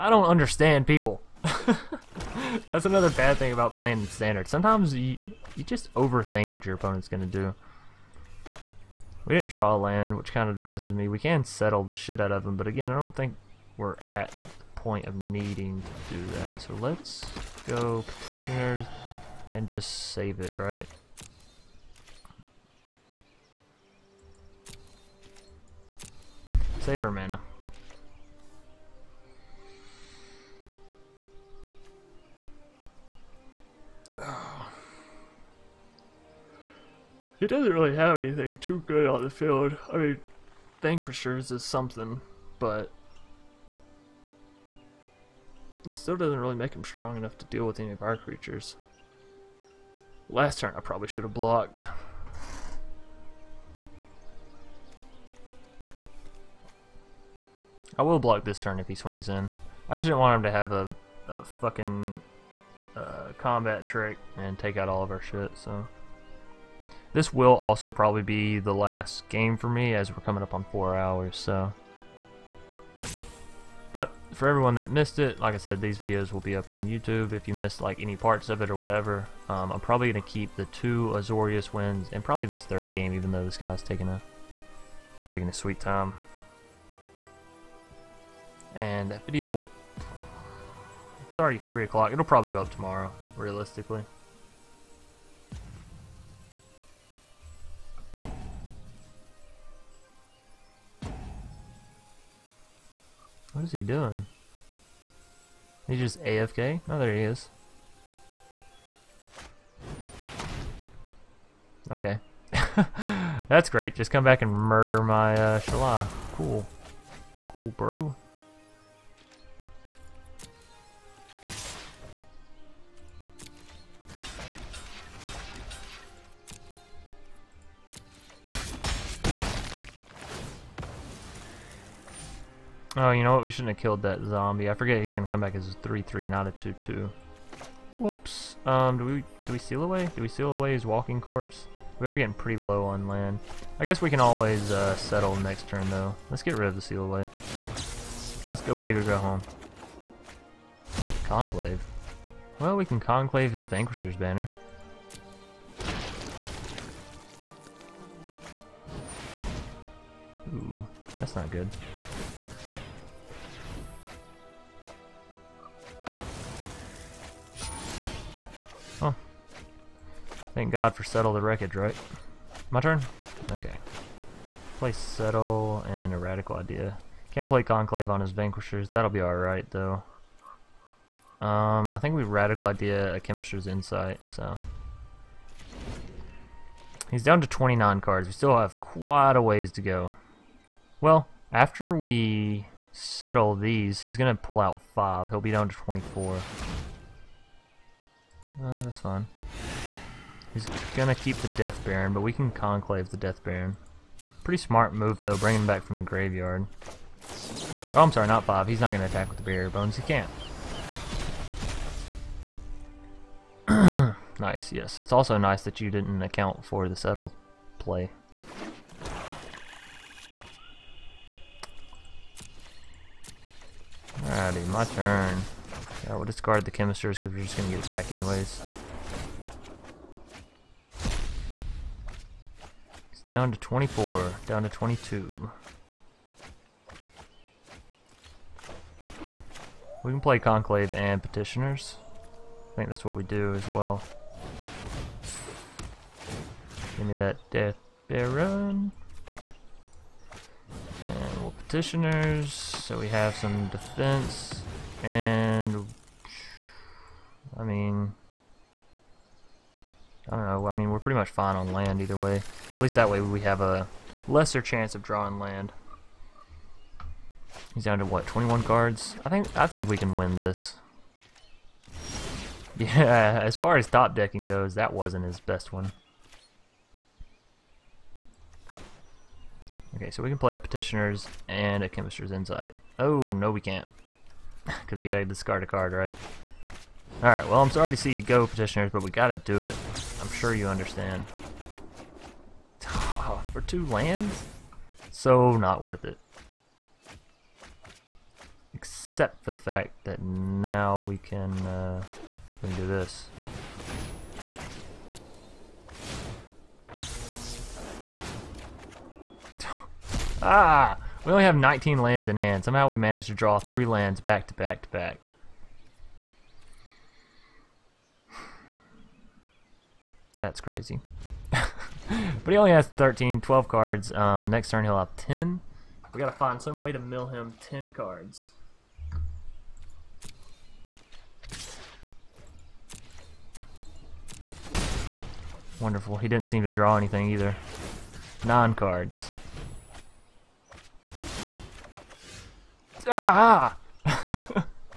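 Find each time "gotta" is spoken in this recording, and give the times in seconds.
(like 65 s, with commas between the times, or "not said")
285 s, 289 s, 326 s.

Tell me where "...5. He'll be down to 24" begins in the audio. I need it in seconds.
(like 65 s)
194 s.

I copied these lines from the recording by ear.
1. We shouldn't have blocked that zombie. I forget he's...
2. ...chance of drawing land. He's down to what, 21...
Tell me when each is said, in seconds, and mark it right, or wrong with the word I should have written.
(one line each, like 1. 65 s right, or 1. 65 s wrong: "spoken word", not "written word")
1. 133 s wrong: "killed", not "blocked"
2. 264 s right.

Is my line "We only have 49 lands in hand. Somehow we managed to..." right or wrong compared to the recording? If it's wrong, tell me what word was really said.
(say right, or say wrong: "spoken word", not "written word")
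wrong: "19", not "49".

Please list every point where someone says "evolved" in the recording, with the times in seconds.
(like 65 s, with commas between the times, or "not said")
not said.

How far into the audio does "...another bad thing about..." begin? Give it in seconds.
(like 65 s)
2 s.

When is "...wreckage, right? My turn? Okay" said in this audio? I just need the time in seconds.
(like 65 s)
171 s.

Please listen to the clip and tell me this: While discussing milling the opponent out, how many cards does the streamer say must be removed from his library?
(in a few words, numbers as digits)
10.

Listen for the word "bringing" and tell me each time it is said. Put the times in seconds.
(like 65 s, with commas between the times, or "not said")
205 s.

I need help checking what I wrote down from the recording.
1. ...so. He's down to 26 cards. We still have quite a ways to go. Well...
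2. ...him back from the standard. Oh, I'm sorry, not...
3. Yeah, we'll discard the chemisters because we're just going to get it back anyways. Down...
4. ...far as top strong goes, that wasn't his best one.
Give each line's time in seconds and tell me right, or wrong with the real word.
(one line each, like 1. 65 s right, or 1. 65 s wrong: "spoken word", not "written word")
1. 184 s wrong: "29", not "26"
2. 205 s wrong: "graveyard", not "standard"
3. 226 s right
4. 273 s wrong: "decking", not "strong".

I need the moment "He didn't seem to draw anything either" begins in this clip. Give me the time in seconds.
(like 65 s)
336 s.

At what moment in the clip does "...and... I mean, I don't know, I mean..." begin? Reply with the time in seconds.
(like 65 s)
255 s.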